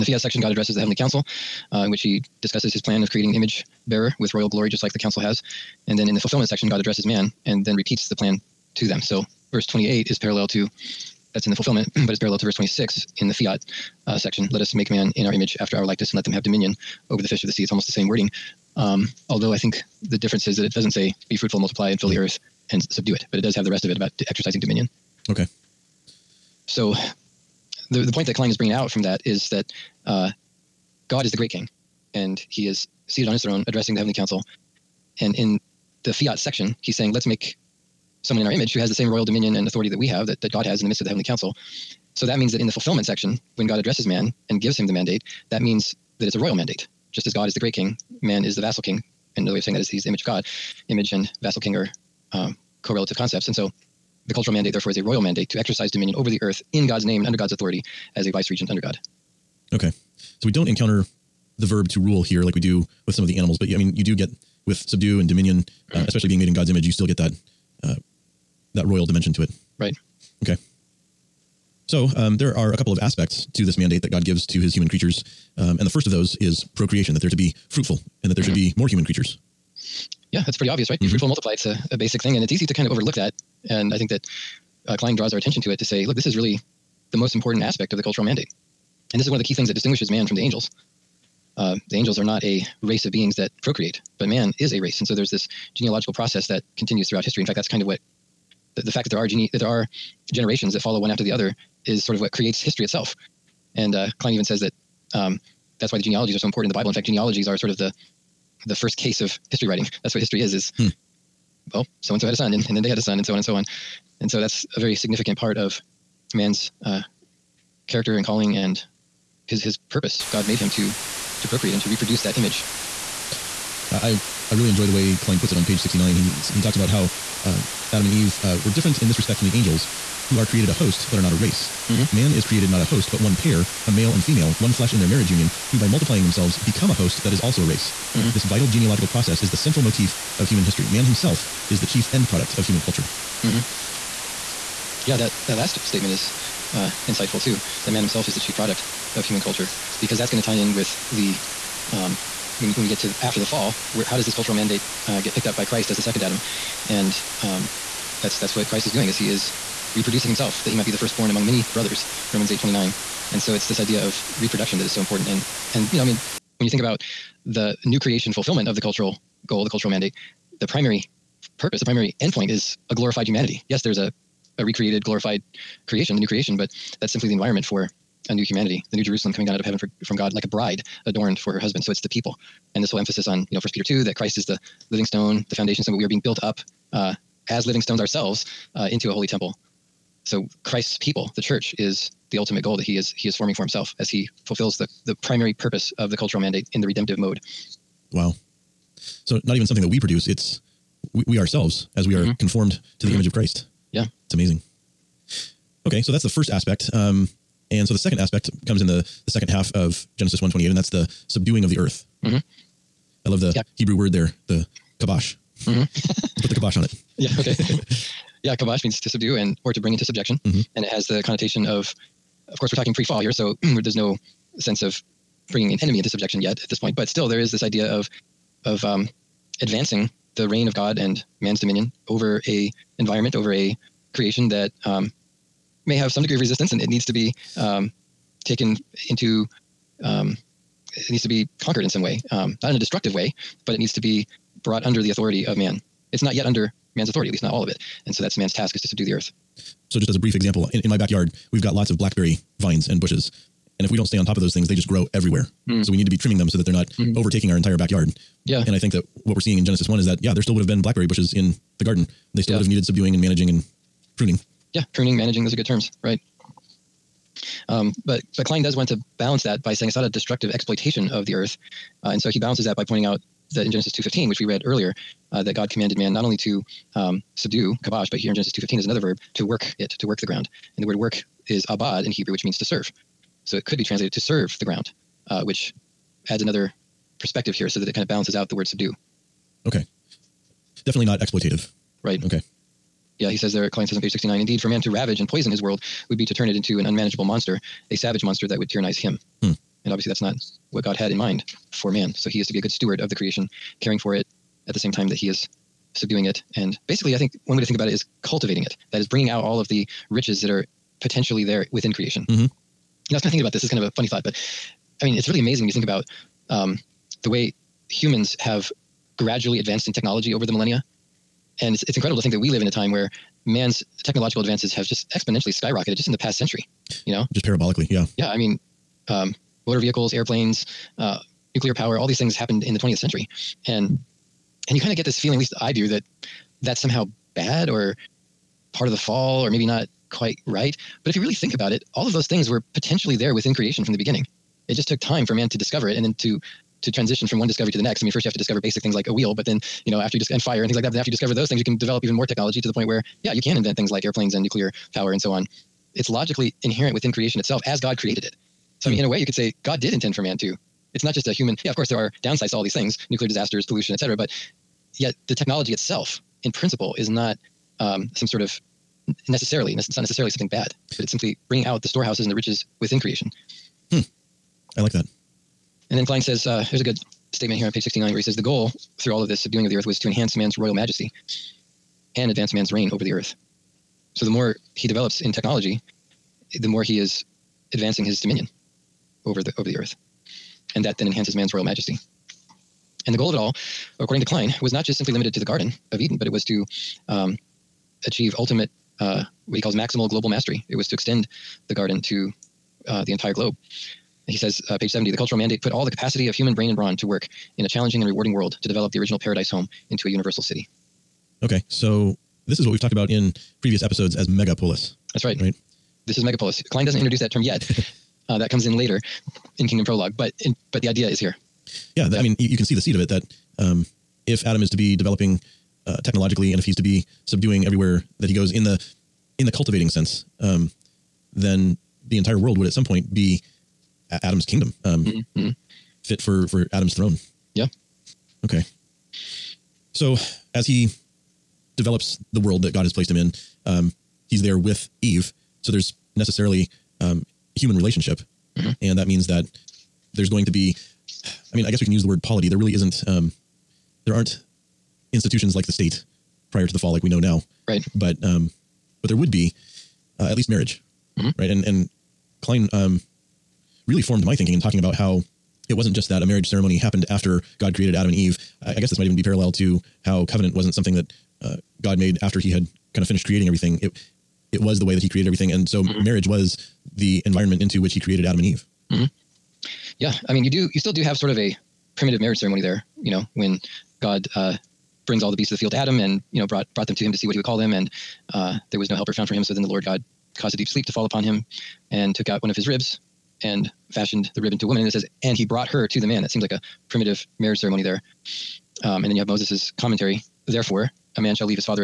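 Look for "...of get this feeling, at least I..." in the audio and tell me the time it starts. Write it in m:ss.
5:34.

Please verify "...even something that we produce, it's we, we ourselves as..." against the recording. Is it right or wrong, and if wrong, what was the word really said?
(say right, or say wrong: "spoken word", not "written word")
right.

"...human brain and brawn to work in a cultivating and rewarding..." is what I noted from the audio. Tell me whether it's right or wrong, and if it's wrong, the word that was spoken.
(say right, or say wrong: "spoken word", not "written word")
wrong: "challenging", not "cultivating".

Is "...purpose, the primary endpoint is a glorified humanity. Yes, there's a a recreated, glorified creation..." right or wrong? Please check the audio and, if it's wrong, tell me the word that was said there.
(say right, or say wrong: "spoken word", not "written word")
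right.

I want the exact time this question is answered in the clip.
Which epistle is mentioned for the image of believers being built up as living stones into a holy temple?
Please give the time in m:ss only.
3:03.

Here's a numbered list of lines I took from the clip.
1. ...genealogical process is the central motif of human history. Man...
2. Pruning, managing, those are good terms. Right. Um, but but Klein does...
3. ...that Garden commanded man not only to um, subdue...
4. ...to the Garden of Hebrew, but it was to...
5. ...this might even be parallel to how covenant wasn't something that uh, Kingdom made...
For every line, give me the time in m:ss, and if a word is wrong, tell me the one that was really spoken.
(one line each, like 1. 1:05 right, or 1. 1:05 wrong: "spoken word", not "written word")
1. 2:18 right
2. 4:24 right
3. 4:35 wrong: "God", not "Garden"
4. 6:35 wrong: "Eden", not "Hebrew"
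5. 7:48 wrong: "God", not "Kingdom".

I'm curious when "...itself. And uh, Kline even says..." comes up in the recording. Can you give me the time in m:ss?
1:42.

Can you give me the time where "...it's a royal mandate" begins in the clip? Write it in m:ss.
0:46.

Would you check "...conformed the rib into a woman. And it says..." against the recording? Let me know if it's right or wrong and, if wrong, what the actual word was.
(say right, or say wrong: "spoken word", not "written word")
wrong: "fashioned", not "conformed".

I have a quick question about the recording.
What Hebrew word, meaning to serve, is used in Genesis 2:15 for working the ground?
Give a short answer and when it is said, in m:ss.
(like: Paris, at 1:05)
abad, at 4:41.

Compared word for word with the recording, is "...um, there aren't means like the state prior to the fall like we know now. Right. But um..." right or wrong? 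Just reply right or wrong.
wrong.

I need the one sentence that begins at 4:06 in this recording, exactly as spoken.
It's not yet under man's authority, at least not all of it.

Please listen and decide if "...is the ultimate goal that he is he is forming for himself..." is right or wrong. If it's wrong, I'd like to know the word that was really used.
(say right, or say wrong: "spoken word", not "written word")
right.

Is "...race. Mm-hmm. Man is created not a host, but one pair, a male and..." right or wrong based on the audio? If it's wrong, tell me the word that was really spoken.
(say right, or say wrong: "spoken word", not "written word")
right.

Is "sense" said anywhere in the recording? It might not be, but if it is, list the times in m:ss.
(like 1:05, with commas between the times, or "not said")
3:44, 7:09.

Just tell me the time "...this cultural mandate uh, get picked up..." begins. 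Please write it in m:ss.
2:34.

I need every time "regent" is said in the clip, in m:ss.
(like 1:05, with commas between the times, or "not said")
0:58.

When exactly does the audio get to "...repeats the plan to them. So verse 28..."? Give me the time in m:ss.
0:07.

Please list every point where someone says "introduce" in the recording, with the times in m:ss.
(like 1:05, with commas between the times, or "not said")
6:56.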